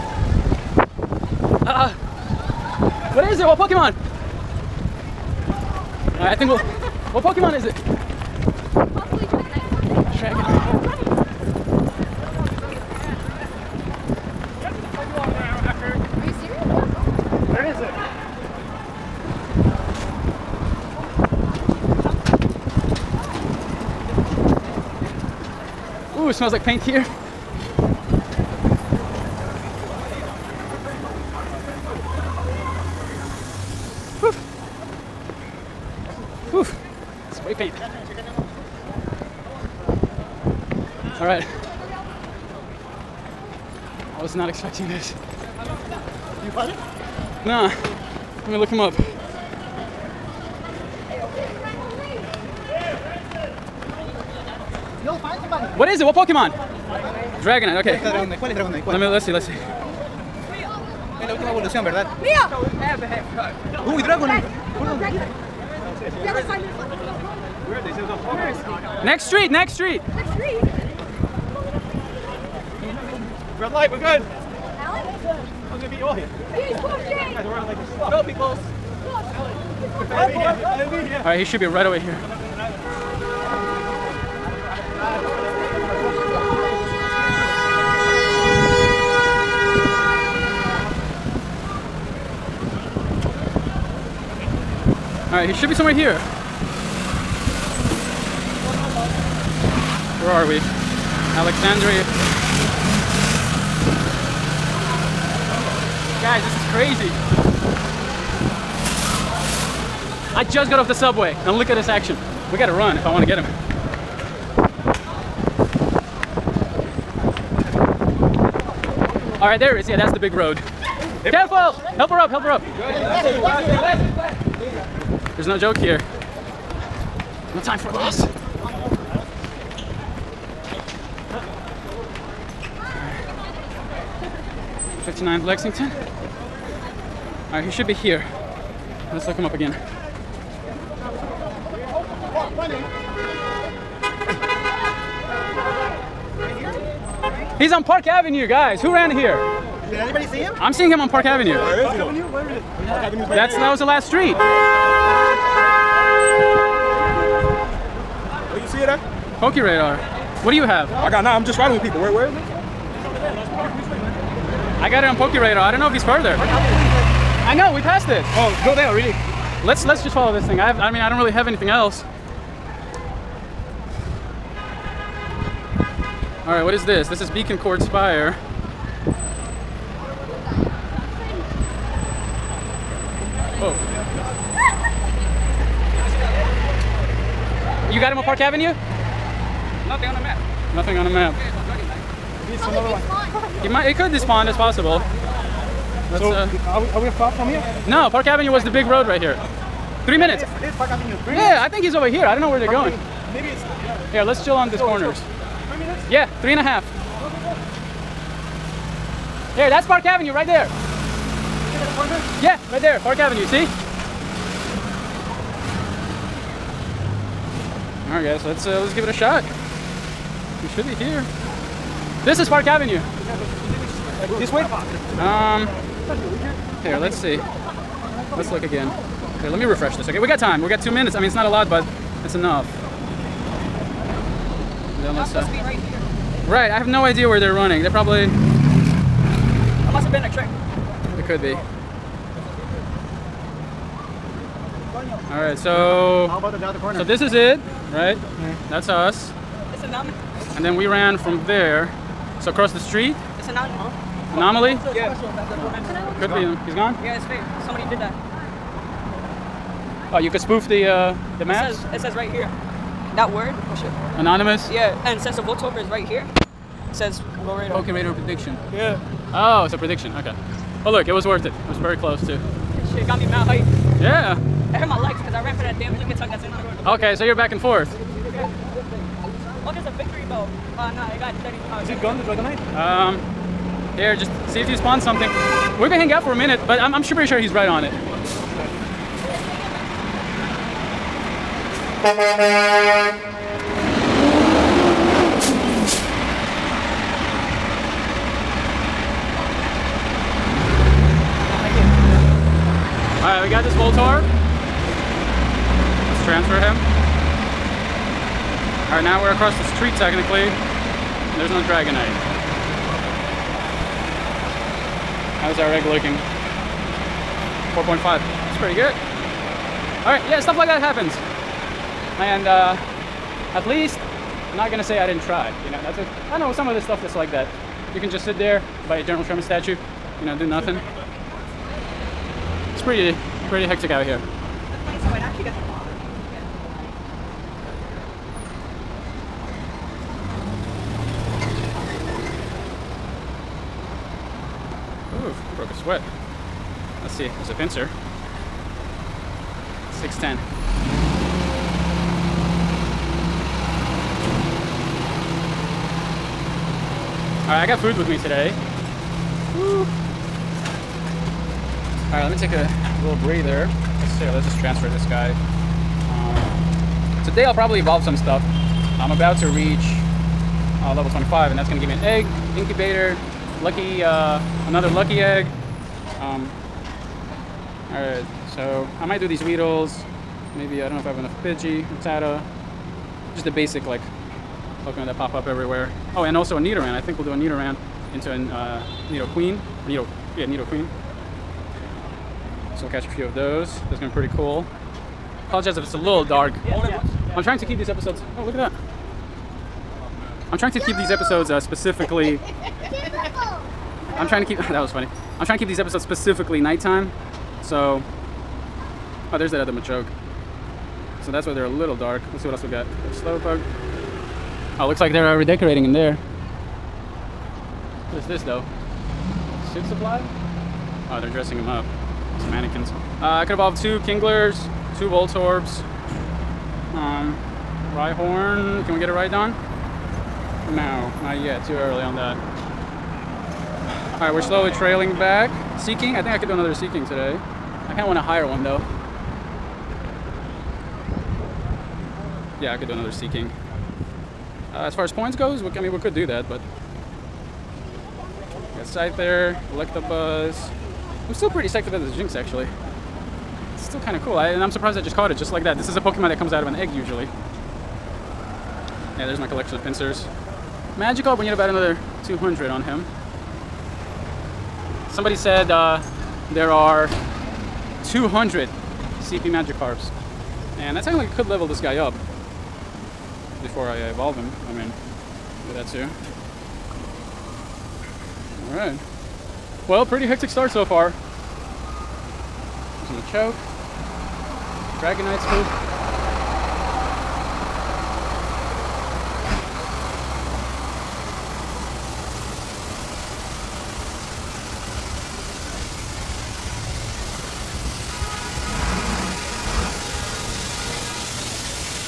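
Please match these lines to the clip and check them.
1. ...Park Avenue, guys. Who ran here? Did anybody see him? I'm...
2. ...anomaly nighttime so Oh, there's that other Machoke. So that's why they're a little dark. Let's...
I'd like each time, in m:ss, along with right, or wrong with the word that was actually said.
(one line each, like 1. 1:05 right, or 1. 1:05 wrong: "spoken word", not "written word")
1. 2:27 right
2. 6:46 wrong: "specifically", not "anomaly".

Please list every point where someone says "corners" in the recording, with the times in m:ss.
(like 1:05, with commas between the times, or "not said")
3:24, 4:06.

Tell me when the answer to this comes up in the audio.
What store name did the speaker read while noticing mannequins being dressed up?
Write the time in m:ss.
6:59.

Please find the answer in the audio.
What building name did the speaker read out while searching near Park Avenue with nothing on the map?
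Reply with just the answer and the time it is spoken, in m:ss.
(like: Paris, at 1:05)
Beacon Court Spire, at 2:57.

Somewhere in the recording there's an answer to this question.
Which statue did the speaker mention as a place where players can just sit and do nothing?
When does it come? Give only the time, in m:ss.
5:29.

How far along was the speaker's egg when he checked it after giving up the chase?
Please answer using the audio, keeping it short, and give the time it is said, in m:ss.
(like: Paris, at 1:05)
4.5, at 5:17.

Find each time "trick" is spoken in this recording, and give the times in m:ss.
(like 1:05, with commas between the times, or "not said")
4:00.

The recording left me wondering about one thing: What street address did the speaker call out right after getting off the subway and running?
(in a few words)
59 Lexington.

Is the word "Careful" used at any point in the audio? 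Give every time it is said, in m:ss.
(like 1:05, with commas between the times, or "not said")
2:01.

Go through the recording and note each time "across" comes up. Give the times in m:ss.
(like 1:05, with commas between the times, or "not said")
4:12, 5:09.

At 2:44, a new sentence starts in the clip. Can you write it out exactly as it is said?
I got it on Pokey radar.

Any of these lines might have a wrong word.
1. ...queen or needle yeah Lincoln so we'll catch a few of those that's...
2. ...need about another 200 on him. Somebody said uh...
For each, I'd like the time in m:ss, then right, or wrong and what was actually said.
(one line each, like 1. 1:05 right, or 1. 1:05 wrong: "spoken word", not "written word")
1. 6:29 wrong: "Nidoqueen", not "Lincoln"
2. 7:41 right.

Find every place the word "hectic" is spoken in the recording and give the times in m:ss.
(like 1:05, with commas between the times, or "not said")
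5:33, 8:00.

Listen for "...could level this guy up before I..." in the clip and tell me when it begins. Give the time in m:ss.
7:51.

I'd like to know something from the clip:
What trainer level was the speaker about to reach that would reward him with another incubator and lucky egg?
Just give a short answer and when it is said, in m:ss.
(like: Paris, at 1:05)
25, at 6:10.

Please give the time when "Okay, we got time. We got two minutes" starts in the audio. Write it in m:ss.
3:50.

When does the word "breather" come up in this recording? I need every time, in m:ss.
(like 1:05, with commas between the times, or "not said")
6:03.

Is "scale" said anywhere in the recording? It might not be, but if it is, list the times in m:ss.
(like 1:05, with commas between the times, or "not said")
not said.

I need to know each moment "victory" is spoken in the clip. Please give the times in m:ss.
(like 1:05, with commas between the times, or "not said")
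4:39.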